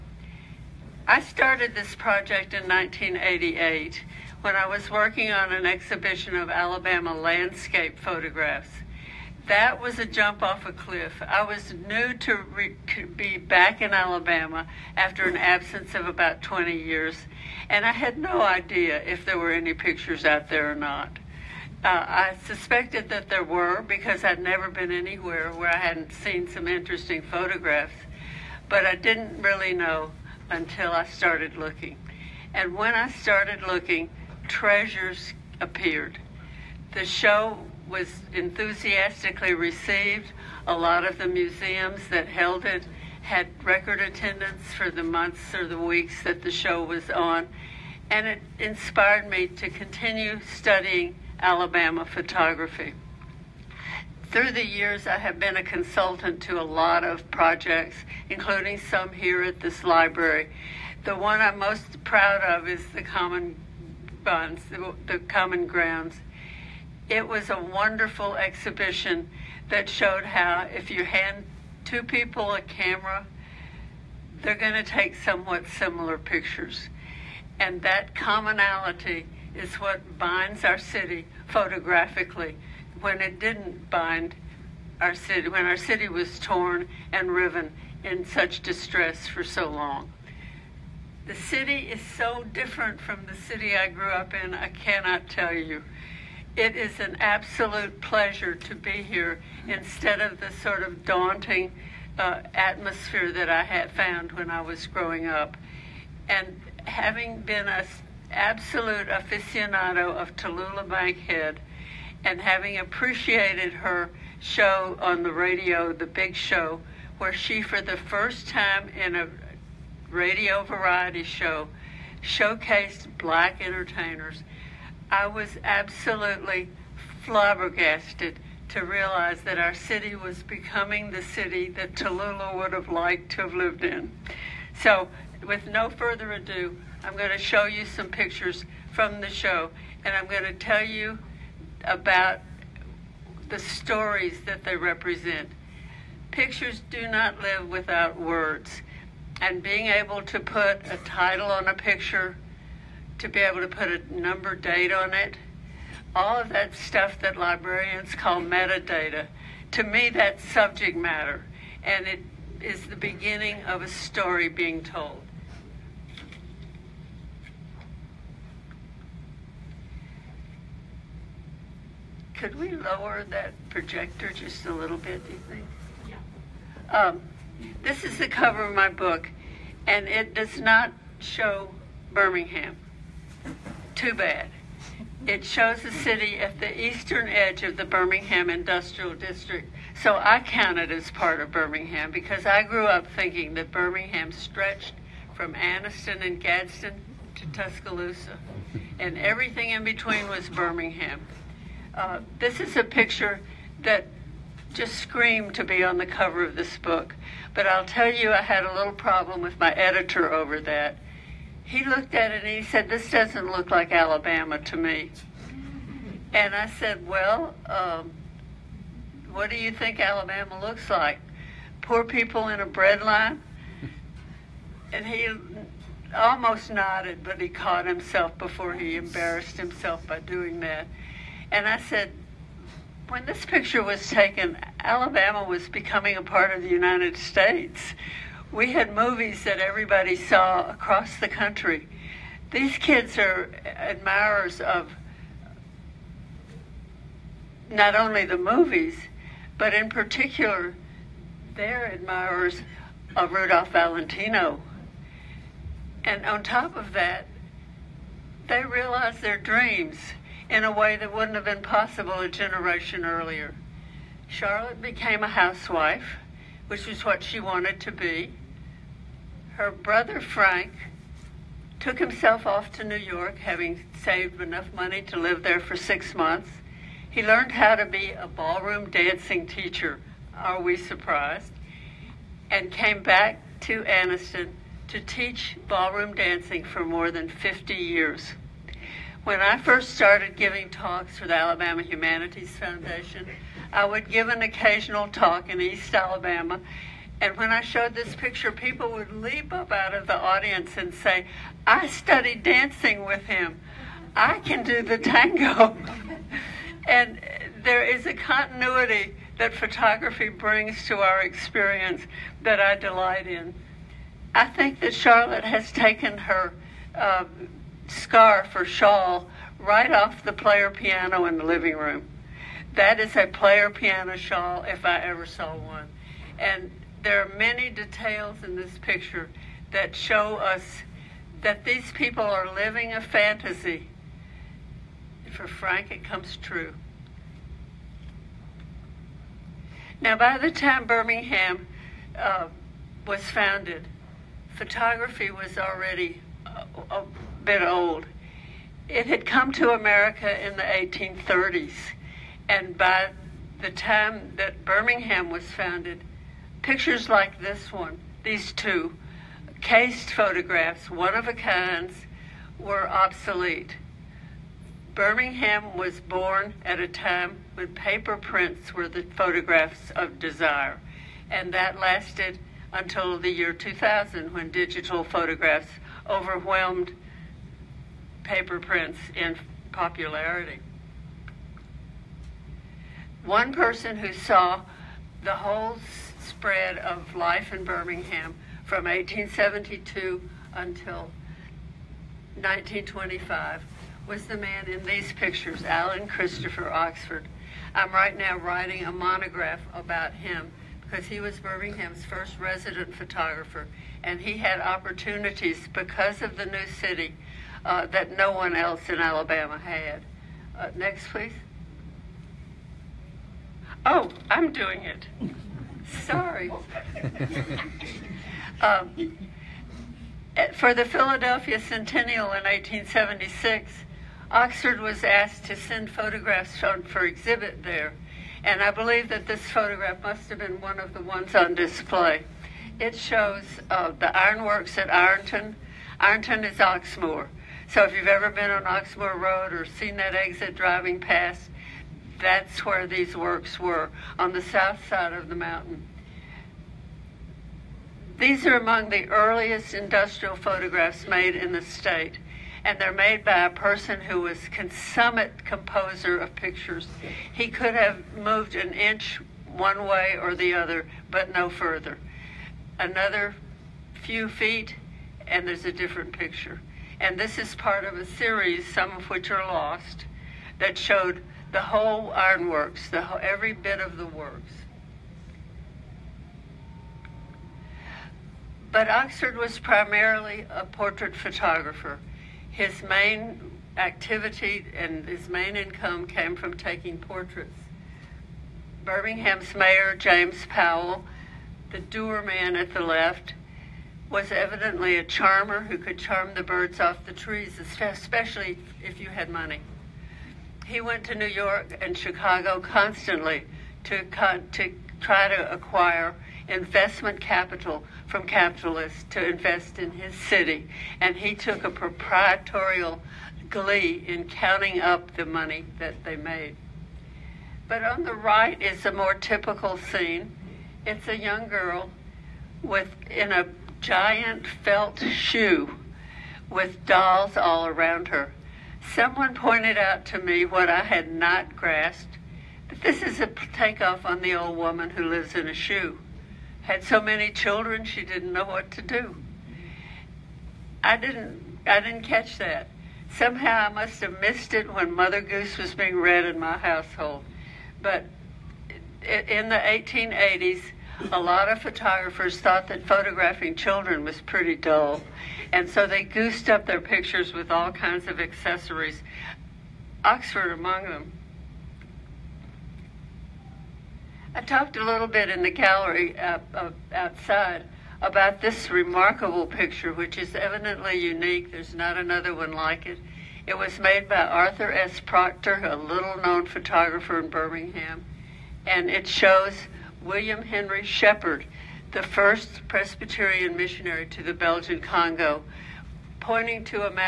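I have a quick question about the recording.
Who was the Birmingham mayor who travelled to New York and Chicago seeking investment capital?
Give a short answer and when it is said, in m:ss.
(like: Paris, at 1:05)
James Powell, at 8:09.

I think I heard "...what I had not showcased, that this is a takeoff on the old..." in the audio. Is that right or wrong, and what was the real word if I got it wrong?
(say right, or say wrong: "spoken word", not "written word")
wrong: "grasped", not "showcased".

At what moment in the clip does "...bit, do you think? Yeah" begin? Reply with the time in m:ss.
2:54.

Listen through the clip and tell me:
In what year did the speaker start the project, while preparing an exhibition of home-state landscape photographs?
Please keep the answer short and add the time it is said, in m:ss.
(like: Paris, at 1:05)
1988, at 0:02.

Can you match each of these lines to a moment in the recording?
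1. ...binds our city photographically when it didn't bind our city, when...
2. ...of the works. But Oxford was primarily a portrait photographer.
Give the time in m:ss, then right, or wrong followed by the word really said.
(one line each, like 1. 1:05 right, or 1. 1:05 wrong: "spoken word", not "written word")
1. 1:20 right
2. 7:53 right.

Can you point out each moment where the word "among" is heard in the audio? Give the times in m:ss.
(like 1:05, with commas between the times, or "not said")
7:28, 9:20.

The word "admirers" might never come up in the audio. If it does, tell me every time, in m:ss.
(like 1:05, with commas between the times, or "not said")
4:03, 4:11.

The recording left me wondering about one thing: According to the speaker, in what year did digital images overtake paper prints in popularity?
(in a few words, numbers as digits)
2000.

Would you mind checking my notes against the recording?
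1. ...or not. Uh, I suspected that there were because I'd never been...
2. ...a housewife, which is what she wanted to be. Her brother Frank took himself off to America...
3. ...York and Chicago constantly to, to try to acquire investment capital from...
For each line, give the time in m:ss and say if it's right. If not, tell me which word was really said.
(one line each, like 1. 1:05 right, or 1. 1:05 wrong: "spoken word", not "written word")
1. 0:20 right
2. 4:25 wrong: "New", not "America"
3. 8:21 right.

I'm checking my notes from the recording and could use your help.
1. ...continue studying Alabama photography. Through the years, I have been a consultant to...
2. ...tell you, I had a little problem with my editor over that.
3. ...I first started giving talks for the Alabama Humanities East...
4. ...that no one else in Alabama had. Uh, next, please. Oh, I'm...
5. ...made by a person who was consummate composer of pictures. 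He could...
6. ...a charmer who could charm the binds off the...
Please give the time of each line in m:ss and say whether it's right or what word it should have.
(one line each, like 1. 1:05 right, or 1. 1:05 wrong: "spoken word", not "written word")
1. 0:49 right
2. 3:27 right
3. 4:49 wrong: "Foundation", not "East"
4. 6:47 right
5. 7:32 right
6. 8:14 wrong: "birds", not "binds".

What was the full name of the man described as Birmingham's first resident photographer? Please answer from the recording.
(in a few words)
Alan Christopher Oxford.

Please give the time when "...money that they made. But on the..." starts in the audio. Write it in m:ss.
8:35.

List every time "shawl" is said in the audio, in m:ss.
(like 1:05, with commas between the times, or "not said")
5:18, 5:24.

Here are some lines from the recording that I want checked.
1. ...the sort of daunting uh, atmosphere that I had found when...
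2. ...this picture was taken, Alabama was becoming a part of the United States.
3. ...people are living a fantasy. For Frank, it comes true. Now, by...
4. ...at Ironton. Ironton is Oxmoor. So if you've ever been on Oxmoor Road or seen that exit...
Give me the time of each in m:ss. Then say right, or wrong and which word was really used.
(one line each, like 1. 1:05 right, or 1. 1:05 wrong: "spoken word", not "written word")
1. 1:40 right
2. 3:53 right
3. 5:31 right
4. 7:14 right.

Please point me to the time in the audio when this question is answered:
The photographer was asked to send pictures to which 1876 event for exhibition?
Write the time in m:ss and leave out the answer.
7:00.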